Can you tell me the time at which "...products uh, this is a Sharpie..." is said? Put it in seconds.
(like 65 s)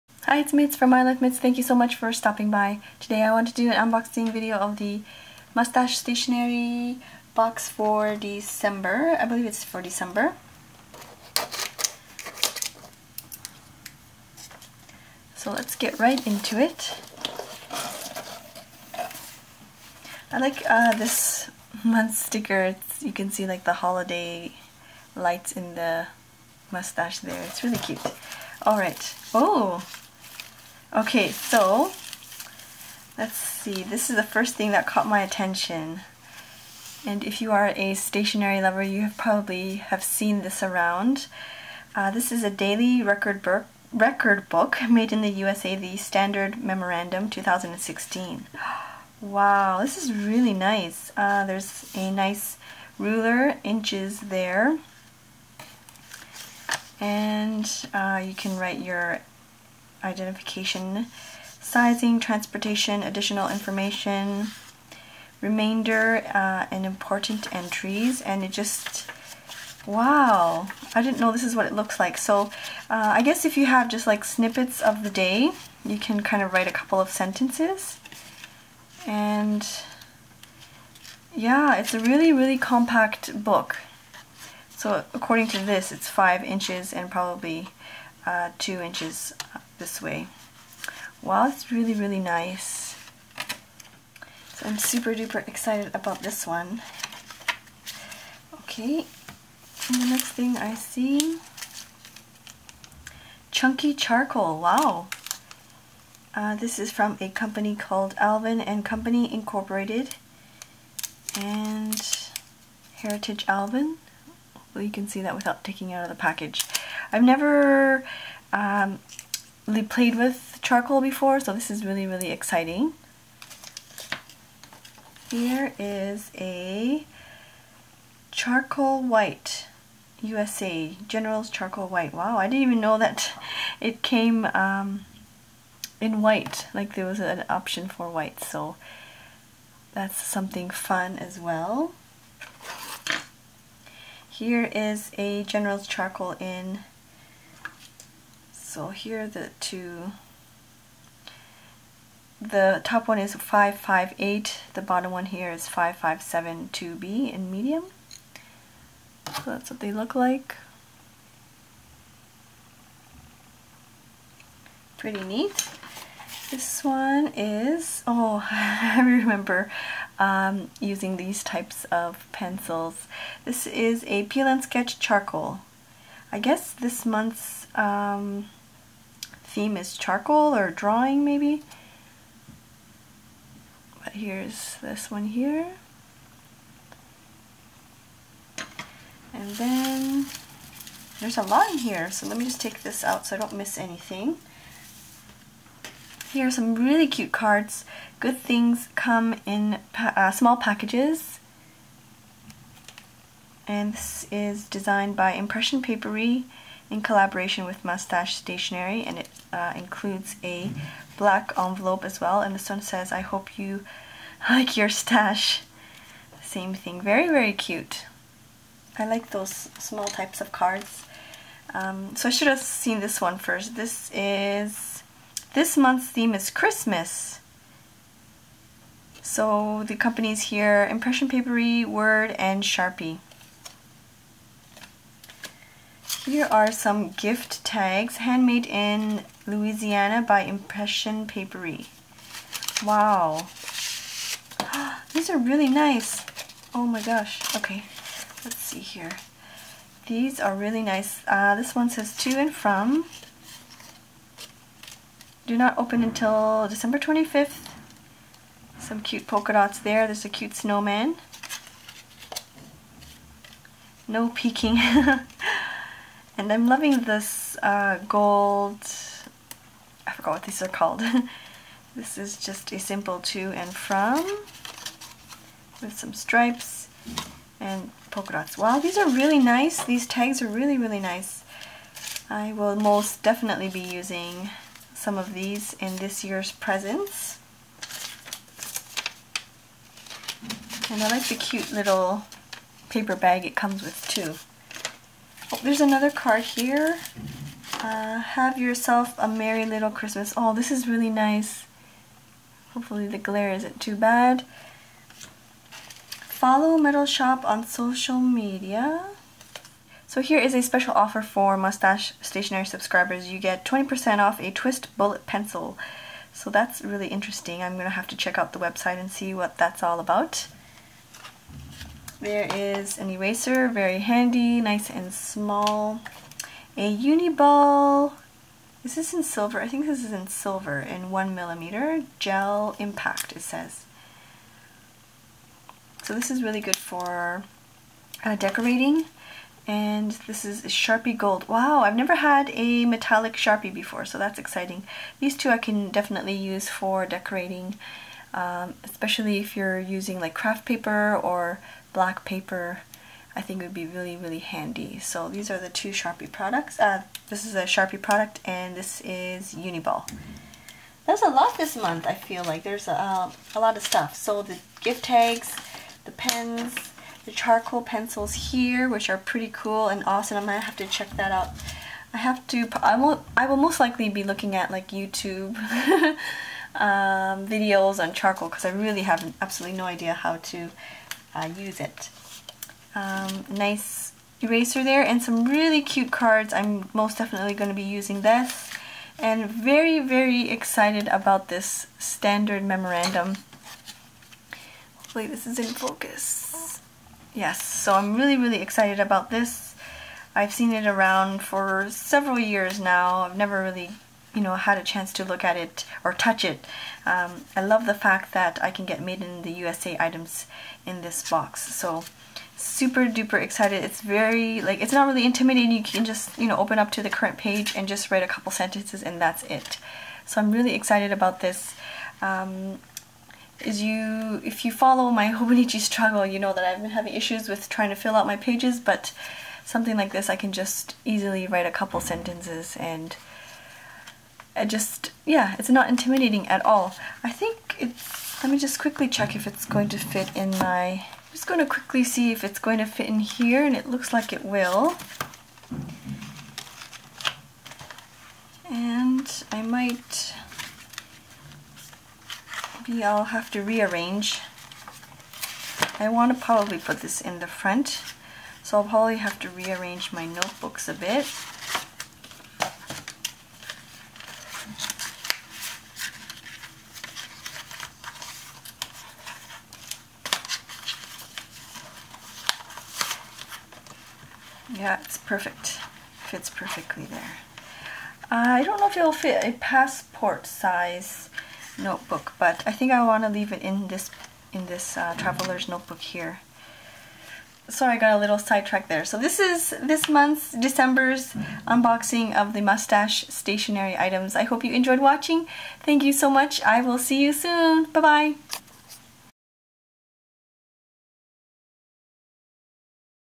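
356 s.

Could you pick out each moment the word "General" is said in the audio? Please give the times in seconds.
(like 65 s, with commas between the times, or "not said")
131 s, 145 s.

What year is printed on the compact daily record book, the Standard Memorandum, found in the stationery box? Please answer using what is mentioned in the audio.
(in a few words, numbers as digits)
2016.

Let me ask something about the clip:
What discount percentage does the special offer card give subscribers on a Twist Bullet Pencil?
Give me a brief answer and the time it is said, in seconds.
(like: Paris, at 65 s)
20%, at 313 s.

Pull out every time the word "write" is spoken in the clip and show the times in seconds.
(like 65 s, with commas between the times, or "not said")
58 s, 76 s, 418 s, 431 s.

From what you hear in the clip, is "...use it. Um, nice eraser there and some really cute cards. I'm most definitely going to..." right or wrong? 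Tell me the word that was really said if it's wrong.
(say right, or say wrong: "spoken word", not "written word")
right.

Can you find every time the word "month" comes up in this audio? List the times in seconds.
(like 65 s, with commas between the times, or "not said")
21 s, 177 s, 225 s, 361 s, 490 s.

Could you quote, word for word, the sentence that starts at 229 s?
So the companies here, Impression Papery, Word, and Sharpie.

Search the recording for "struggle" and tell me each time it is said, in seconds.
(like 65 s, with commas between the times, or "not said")
425 s.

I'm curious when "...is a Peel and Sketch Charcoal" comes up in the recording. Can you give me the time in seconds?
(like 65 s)
173 s.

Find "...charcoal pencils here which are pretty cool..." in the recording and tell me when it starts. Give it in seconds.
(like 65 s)
367 s.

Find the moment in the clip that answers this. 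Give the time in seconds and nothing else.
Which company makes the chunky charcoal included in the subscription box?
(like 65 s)
108 s.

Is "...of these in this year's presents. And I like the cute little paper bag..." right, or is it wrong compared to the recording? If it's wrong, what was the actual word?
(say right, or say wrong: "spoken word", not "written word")
right.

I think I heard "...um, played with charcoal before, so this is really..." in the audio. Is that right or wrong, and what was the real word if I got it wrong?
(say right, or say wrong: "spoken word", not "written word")
right.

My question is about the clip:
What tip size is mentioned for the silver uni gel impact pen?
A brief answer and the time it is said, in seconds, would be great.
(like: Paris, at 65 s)
1 millimeter, at 331 s.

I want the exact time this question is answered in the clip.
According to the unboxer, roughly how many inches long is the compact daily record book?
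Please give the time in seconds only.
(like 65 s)
86 s.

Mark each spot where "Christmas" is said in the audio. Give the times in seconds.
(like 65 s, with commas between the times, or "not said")
226 s, 299 s.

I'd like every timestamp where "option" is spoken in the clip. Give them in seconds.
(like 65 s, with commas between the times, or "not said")
137 s.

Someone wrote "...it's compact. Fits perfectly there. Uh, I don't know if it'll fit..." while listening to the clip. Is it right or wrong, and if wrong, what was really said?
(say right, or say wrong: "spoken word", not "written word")
wrong: "perfect", not "compact".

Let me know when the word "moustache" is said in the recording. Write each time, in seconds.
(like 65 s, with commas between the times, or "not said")
5 s, 207 s, 311 s, 492 s.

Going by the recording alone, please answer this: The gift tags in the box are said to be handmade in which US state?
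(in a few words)
Louisiana.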